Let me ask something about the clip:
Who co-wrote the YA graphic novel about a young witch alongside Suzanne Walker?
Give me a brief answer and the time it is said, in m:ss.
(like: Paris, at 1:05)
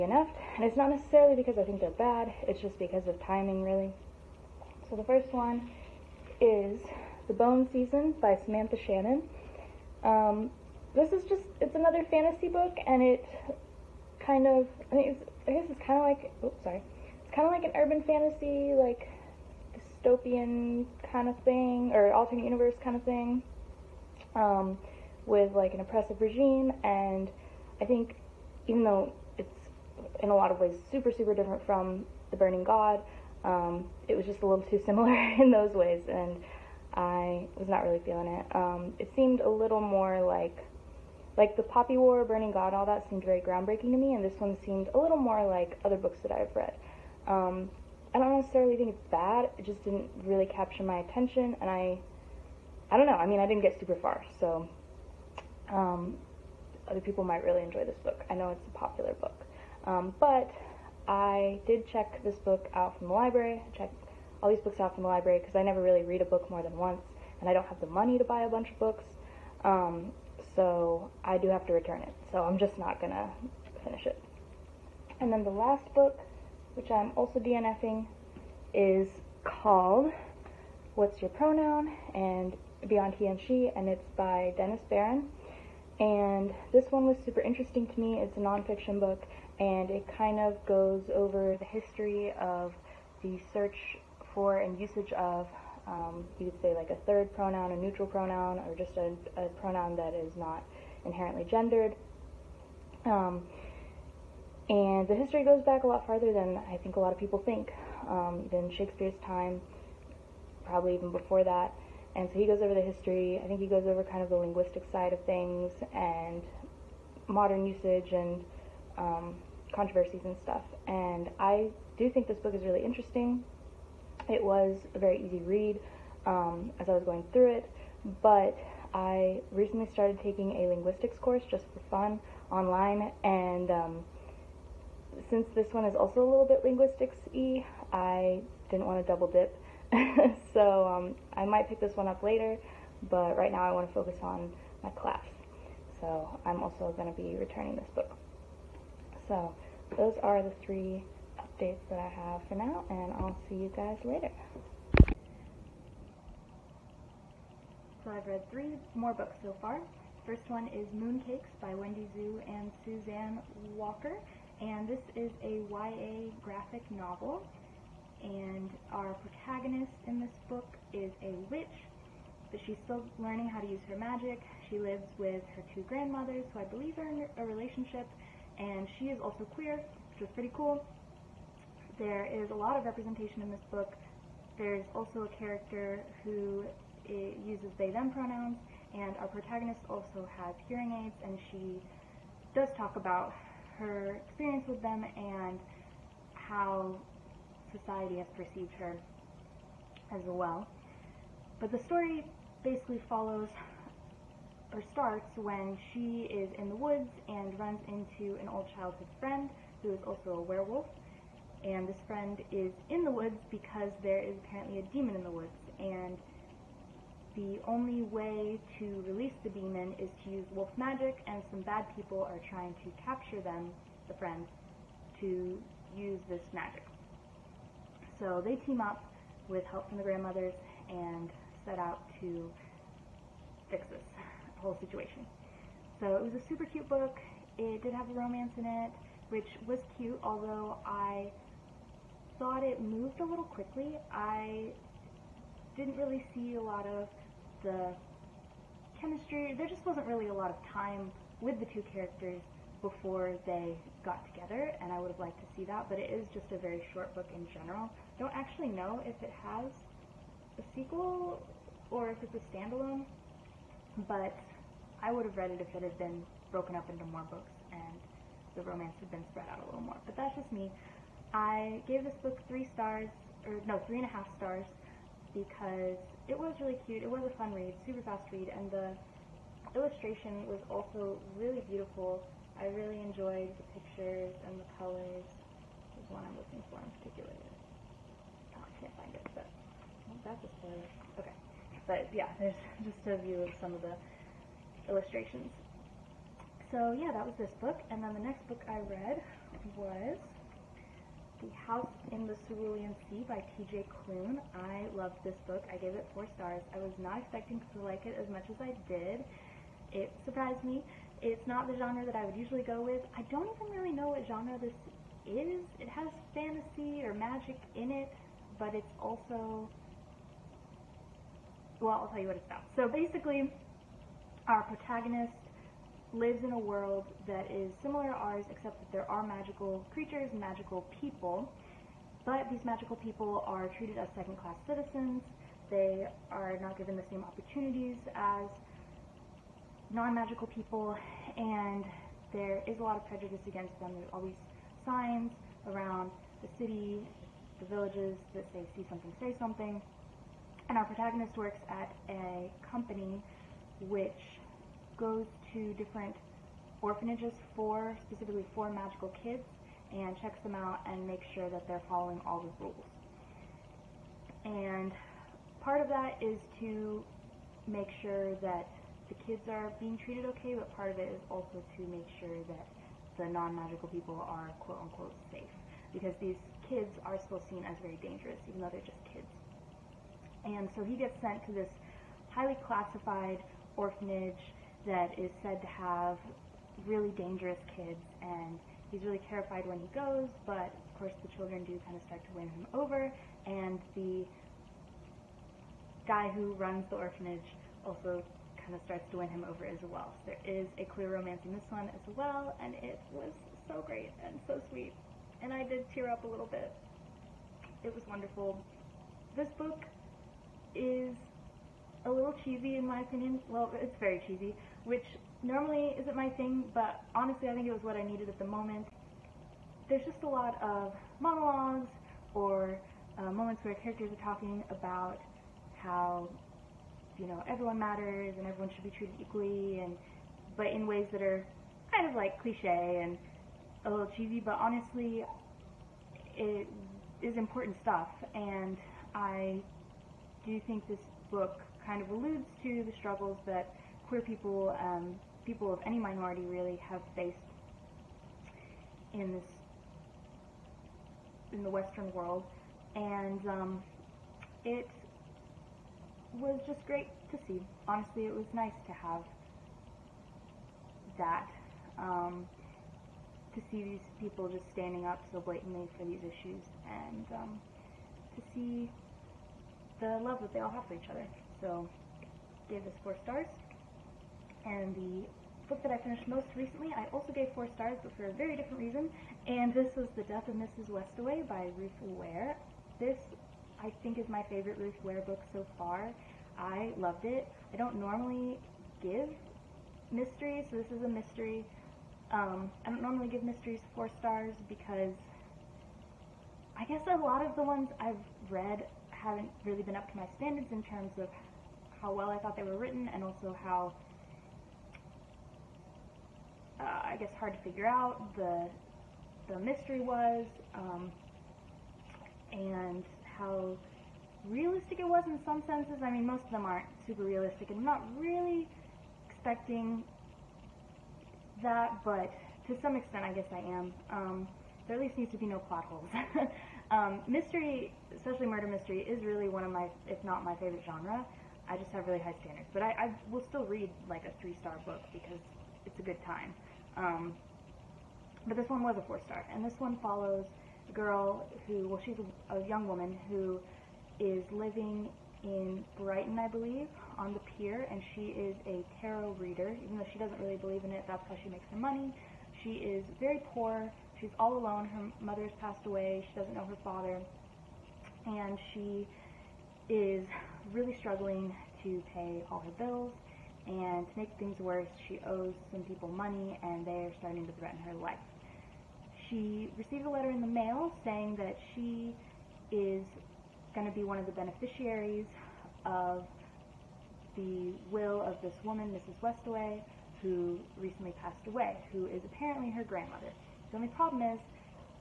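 Wendy Xu, at 2:41.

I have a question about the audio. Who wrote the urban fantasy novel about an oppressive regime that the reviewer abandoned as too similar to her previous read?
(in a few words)
Samantha Shannon.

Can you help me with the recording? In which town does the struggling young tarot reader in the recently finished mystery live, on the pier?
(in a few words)
Brighton.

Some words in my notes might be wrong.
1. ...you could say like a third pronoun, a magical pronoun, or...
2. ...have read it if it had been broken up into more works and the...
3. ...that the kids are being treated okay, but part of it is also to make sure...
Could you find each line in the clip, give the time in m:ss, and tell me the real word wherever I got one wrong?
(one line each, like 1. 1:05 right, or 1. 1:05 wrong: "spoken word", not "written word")
1. 1:36 wrong: "neutral", not "magical"
2. 4:25 wrong: "books", not "works"
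3. 6:08 right.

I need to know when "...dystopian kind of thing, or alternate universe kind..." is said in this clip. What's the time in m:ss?
0:20.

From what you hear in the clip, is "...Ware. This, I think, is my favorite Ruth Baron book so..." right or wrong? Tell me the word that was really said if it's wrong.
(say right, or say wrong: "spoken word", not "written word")
wrong: "Ware", not "Baron".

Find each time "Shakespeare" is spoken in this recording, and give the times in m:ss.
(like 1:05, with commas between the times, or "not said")
1:48.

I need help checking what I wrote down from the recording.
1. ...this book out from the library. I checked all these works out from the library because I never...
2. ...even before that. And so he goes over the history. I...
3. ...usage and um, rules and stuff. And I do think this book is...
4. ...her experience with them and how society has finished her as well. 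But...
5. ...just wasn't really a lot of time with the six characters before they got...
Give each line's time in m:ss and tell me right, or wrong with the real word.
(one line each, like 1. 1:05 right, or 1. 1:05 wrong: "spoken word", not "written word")
1. 1:02 wrong: "books", not "works"
2. 1:50 right
3. 1:57 wrong: "controversies", not "rules"
4. 3:13 wrong: "perceived", not "finished"
5. 4:09 wrong: "two", not "six".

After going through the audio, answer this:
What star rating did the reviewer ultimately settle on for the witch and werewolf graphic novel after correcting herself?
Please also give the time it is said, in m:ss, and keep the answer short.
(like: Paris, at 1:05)
3.5 stars, at 4:33.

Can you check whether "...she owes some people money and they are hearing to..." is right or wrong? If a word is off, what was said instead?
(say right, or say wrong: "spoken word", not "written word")
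wrong: "starting", not "hearing".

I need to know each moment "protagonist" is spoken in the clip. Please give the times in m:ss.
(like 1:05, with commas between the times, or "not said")
2:49, 3:09, 5:24, 5:50.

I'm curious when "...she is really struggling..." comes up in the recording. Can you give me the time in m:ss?
9:18.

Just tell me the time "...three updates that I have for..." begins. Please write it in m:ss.
2:30.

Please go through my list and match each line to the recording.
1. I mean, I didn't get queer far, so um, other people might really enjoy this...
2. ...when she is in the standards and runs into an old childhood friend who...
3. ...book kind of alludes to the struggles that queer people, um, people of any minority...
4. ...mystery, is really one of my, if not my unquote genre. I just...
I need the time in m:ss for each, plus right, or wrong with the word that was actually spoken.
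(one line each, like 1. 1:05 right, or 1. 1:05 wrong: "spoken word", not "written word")
1. 0:53 wrong: "super", not "queer"
2. 3:25 wrong: "woods", not "standards"
3. 7:21 right
4. 8:48 wrong: "favorite", not "unquote".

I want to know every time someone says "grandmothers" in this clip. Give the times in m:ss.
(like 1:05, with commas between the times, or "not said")
2:55, 3:50, 9:42.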